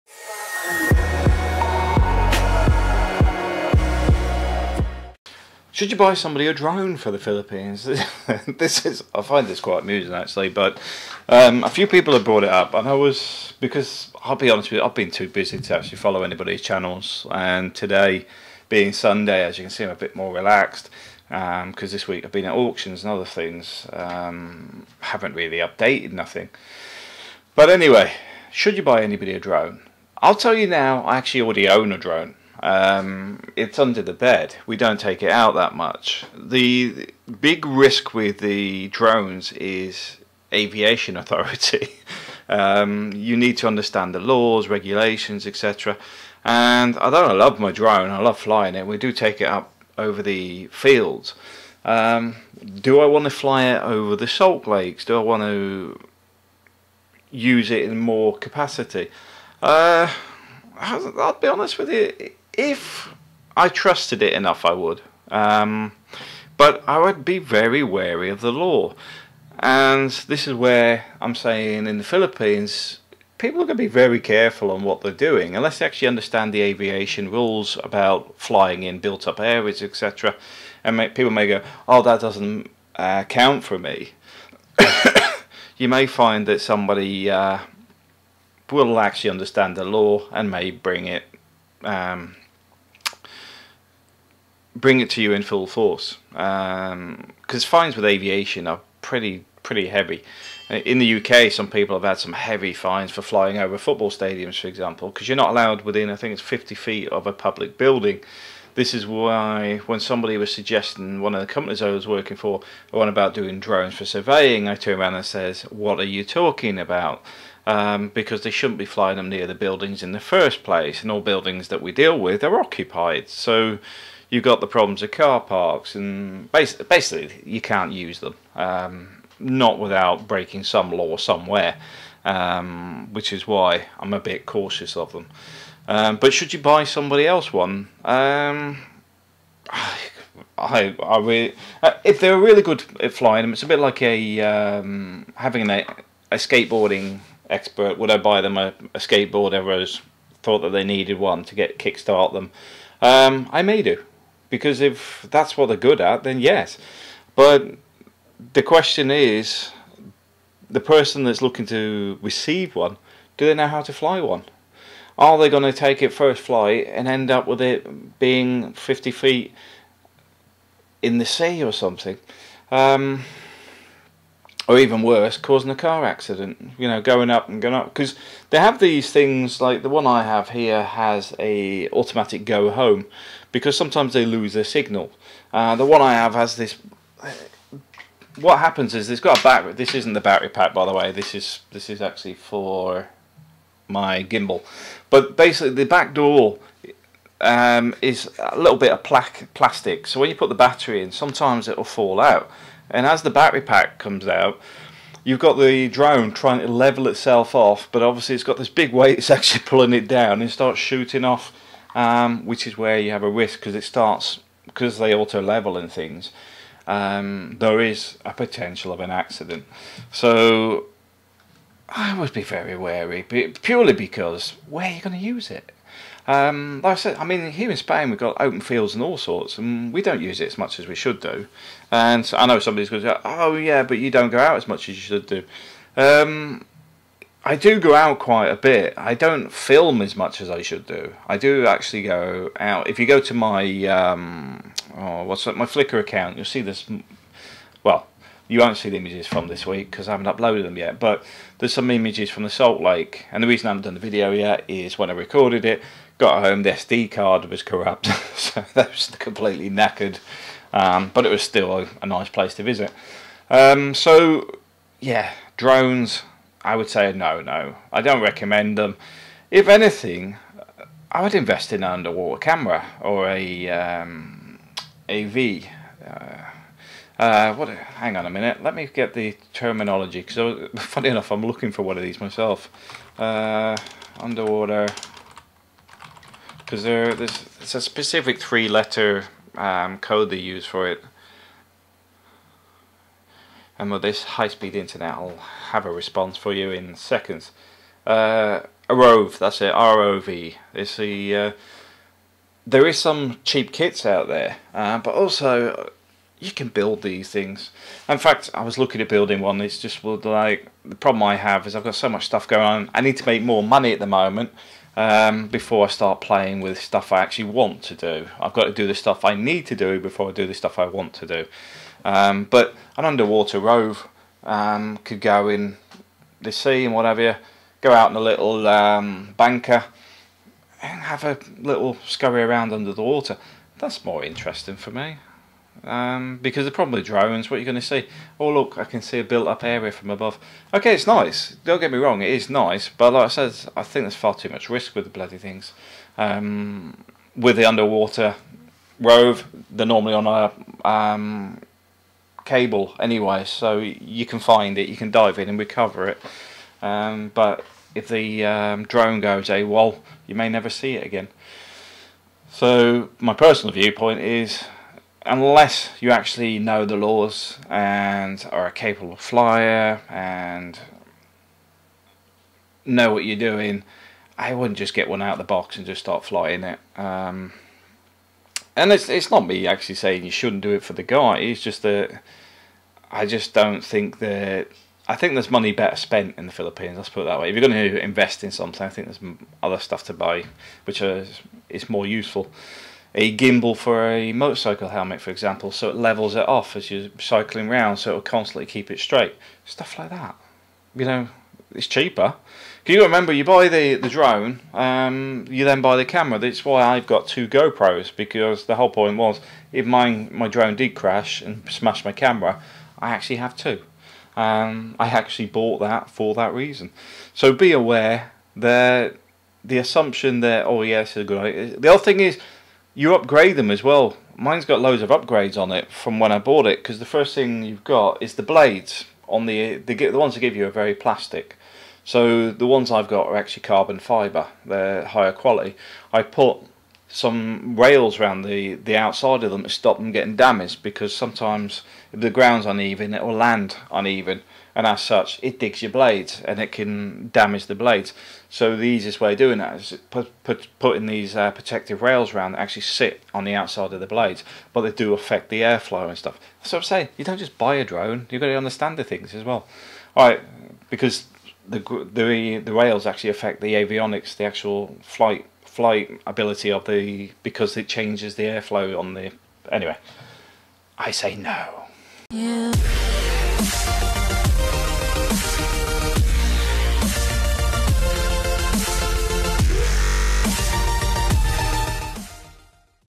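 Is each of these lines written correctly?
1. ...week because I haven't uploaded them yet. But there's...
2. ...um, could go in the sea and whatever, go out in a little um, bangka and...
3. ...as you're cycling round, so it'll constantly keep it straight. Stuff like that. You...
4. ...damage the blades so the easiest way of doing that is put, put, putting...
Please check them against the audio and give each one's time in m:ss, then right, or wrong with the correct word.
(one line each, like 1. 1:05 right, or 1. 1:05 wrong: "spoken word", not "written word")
1. 4:09 right
2. 5:24 right
3. 6:36 right
4. 7:27 right.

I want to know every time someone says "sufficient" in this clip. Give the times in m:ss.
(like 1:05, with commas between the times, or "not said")
not said.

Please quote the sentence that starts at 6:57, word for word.
So be aware that the assumption that oh yes, yeah, a good idea.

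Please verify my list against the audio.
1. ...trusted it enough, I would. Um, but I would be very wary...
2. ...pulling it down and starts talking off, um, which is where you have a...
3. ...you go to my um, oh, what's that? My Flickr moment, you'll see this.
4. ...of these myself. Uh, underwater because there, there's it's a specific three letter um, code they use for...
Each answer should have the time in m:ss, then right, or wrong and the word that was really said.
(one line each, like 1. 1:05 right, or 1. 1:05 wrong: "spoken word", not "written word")
1. 1:03 right
2. 3:29 wrong: "shooting", not "talking"
3. 4:02 wrong: "account", not "moment"
4. 4:41 right.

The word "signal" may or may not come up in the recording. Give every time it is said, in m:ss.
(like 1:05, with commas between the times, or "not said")
3:04.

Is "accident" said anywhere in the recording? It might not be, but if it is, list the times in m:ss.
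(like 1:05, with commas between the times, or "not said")
2:56, 3:39.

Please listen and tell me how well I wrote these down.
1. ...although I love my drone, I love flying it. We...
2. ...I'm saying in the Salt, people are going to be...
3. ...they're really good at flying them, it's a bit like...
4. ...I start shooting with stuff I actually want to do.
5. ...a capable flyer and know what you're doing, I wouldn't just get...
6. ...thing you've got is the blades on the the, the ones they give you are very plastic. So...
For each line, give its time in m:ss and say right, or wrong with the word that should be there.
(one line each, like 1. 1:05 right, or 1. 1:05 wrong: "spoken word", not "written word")
1. 0:46 right
2. 1:11 wrong: "Philippines", not "Salt"
3. 2:22 right
4. 5:15 wrong: "playing", not "shooting"
5. 6:08 right
6. 7:07 right.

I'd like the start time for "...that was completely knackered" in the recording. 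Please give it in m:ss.
4:18.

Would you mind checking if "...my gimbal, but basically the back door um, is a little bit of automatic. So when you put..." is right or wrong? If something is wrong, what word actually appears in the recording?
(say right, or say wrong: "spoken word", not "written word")
wrong: "plastic", not "automatic".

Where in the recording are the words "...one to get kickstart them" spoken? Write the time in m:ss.
2:31.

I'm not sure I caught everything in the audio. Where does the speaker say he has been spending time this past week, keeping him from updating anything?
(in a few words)
auctions.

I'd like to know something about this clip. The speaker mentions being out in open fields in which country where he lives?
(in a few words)
Spain.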